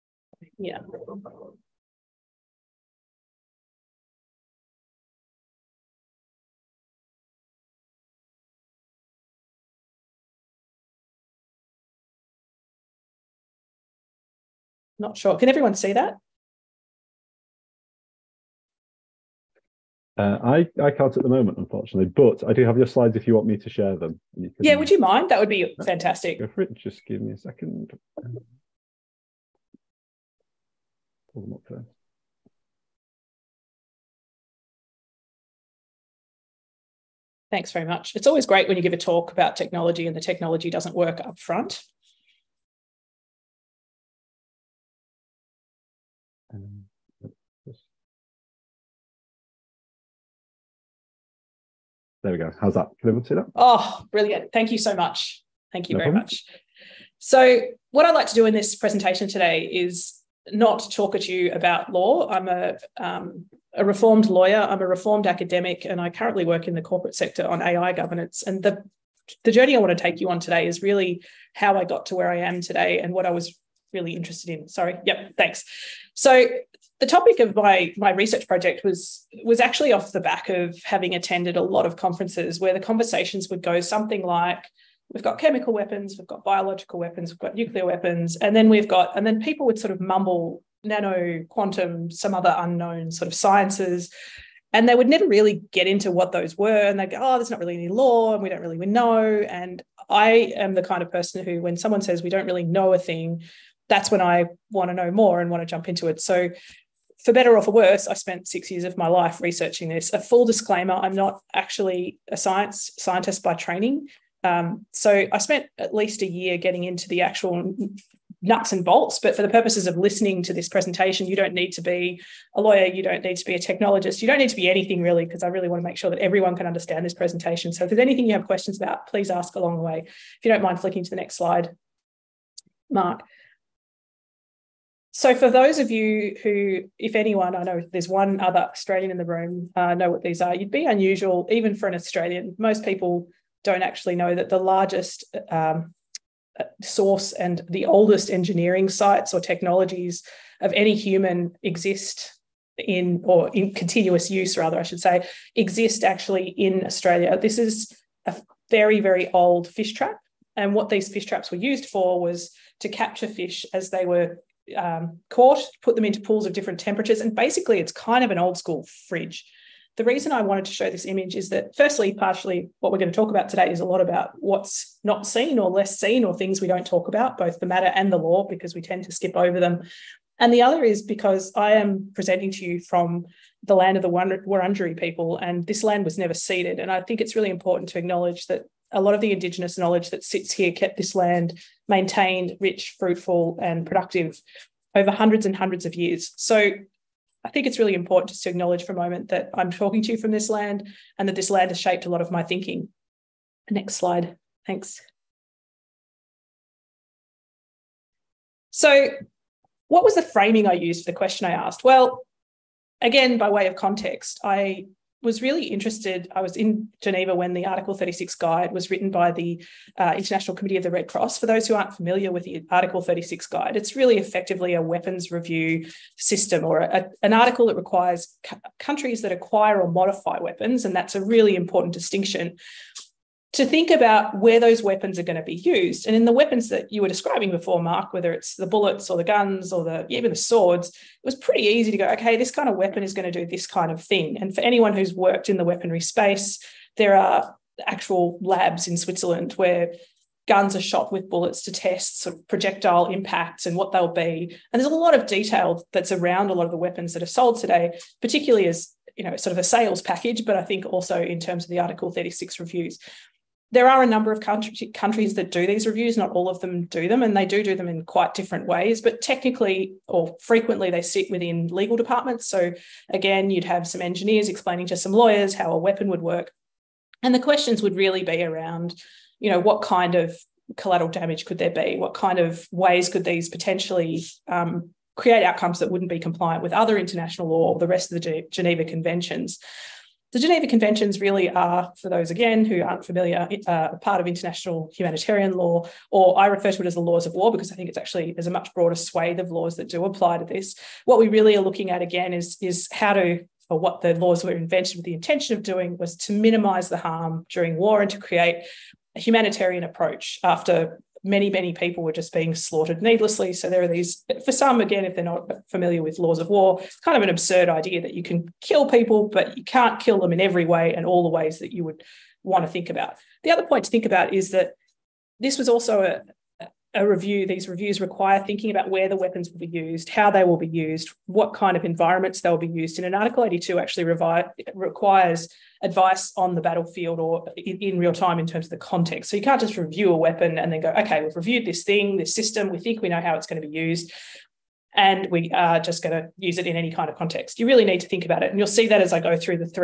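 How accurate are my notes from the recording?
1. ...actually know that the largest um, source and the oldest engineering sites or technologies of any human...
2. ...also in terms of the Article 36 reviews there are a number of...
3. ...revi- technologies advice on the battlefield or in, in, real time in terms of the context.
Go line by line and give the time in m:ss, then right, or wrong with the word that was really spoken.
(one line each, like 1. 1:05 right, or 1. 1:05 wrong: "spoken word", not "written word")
1. 2:23 right
2. 4:20 right
3. 5:34 wrong: "requires", not "technologies".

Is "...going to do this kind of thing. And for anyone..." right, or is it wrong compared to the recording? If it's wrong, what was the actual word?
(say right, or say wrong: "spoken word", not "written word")
right.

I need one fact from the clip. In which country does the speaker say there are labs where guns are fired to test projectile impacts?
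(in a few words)
Switzerland.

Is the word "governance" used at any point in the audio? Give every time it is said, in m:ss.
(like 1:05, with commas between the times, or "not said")
1:07.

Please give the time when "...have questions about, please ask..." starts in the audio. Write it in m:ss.
2:08.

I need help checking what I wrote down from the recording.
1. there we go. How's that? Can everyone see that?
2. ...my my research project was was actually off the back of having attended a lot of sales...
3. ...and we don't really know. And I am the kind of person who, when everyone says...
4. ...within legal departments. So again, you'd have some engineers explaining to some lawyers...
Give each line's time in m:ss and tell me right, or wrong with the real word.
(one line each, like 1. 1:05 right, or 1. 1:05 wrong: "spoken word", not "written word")
1. 0:52 right
2. 1:17 wrong: "conferences", not "sales"
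3. 1:38 wrong: "someone", not "everyone"
4. 4:31 right.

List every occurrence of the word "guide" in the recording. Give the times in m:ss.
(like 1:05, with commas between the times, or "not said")
3:38, 3:43.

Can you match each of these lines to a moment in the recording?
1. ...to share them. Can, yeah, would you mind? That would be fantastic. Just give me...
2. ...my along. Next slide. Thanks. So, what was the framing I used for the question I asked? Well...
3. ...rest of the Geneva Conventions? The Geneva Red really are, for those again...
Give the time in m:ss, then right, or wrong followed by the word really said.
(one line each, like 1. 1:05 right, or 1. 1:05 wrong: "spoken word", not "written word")
1. 0:23 right
2. 3:22 wrong: "thinking", not "along"
3. 4:47 wrong: "Conventions", not "Red".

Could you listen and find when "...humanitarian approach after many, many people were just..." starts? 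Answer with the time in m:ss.
5:09.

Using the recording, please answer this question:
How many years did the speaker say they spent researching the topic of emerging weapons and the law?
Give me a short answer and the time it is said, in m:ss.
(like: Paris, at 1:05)
6, at 1:48.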